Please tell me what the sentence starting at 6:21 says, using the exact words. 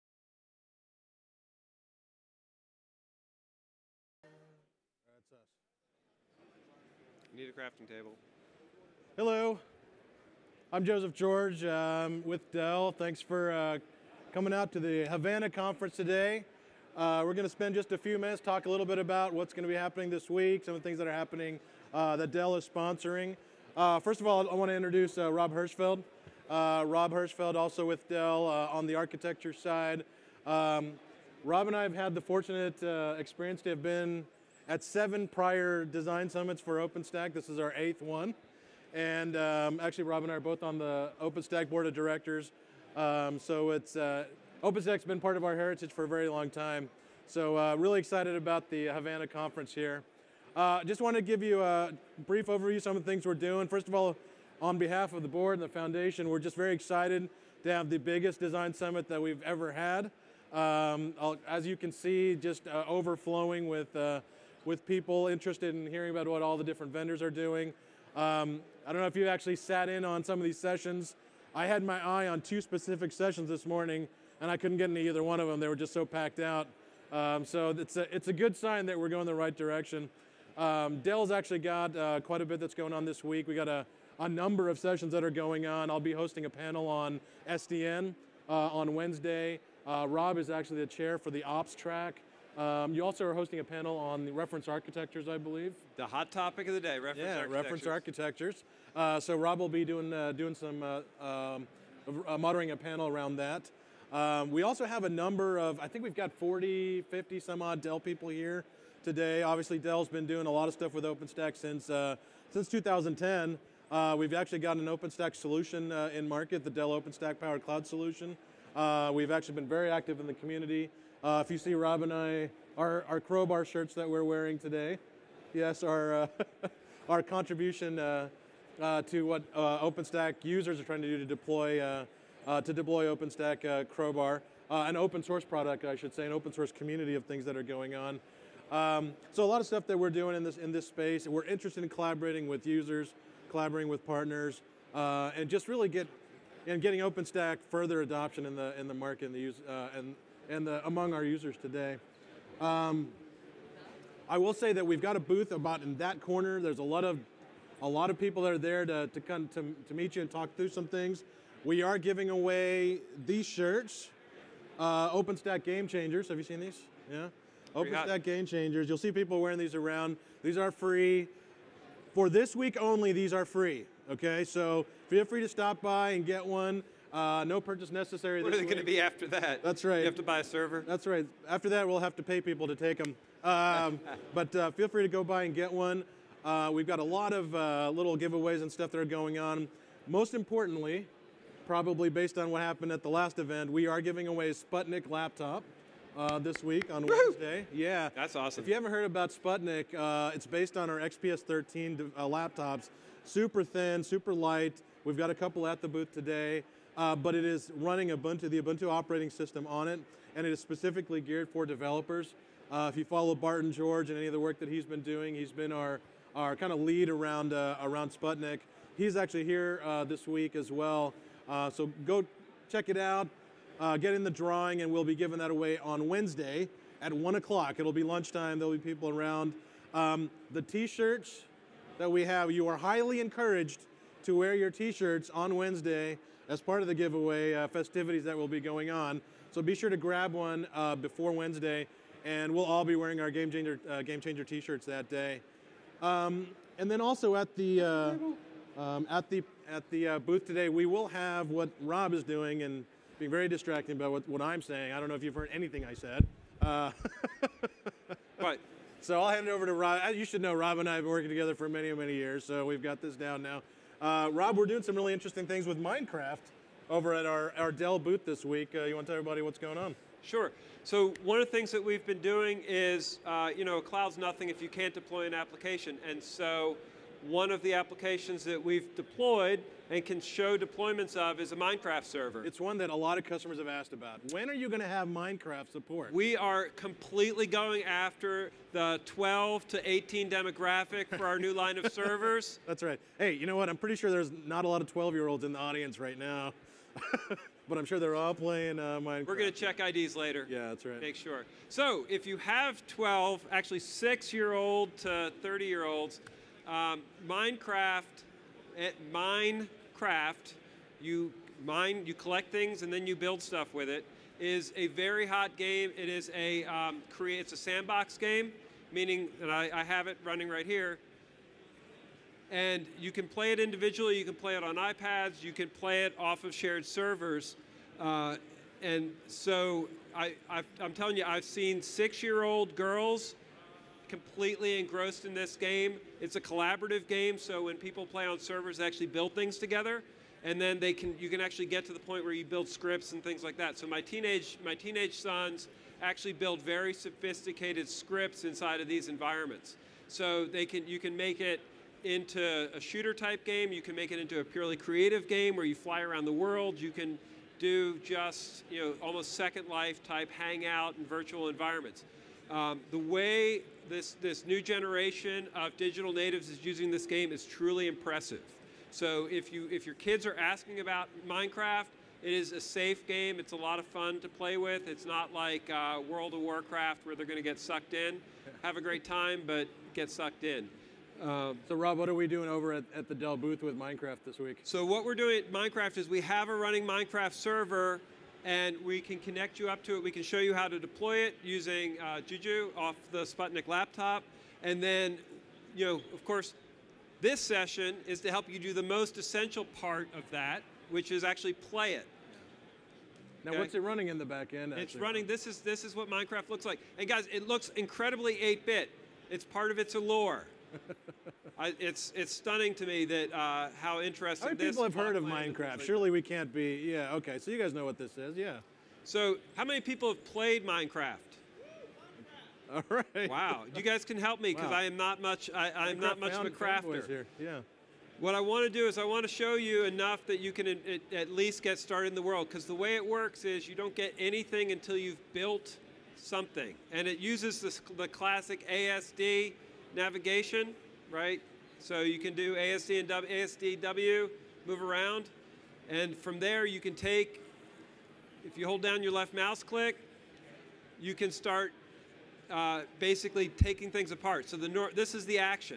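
Um, so Rob, what are we doing over at, at the Dell booth with Minecraft this week?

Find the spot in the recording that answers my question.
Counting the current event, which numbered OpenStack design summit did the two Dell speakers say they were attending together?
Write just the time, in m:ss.
0:37.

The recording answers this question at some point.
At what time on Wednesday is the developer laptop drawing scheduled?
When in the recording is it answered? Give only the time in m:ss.
3:47.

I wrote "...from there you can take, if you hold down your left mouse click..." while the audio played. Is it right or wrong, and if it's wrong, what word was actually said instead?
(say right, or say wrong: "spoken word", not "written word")
right.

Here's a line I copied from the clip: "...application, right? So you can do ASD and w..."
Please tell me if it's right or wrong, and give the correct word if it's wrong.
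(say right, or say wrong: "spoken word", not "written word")
wrong: "navigation", not "application".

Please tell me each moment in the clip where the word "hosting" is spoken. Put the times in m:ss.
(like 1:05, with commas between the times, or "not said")
1:26, 1:33.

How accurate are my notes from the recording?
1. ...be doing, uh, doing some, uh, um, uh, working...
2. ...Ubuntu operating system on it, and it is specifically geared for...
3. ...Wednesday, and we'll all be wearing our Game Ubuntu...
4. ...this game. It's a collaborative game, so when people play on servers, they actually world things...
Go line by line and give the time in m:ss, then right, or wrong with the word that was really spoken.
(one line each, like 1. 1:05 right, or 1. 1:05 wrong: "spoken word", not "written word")
1. 1:39 wrong: "moderating", not "working"
2. 3:28 right
3. 4:01 wrong: "Changer", not "Ubuntu"
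4. 5:35 wrong: "build", not "world".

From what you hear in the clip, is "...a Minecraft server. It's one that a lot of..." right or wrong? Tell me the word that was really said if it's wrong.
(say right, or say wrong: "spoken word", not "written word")
right.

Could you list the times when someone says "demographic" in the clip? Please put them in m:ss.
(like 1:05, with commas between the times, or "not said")
4:50.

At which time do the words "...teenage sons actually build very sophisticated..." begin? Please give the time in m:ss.
5:44.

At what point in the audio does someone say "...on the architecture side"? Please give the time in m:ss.
0:28.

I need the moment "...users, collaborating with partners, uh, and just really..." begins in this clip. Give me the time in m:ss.
2:22.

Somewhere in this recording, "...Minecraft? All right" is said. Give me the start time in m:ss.
7:00.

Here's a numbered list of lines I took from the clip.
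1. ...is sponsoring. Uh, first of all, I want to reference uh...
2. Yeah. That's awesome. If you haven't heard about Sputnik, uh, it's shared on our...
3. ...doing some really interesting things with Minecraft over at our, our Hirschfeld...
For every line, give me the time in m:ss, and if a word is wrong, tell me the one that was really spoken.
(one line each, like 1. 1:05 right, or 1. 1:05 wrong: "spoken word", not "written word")
1. 0:22 wrong: "introduce", not "reference"
2. 3:17 wrong: "based", not "shared"
3. 4:24 wrong: "Dell", not "Hirschfeld".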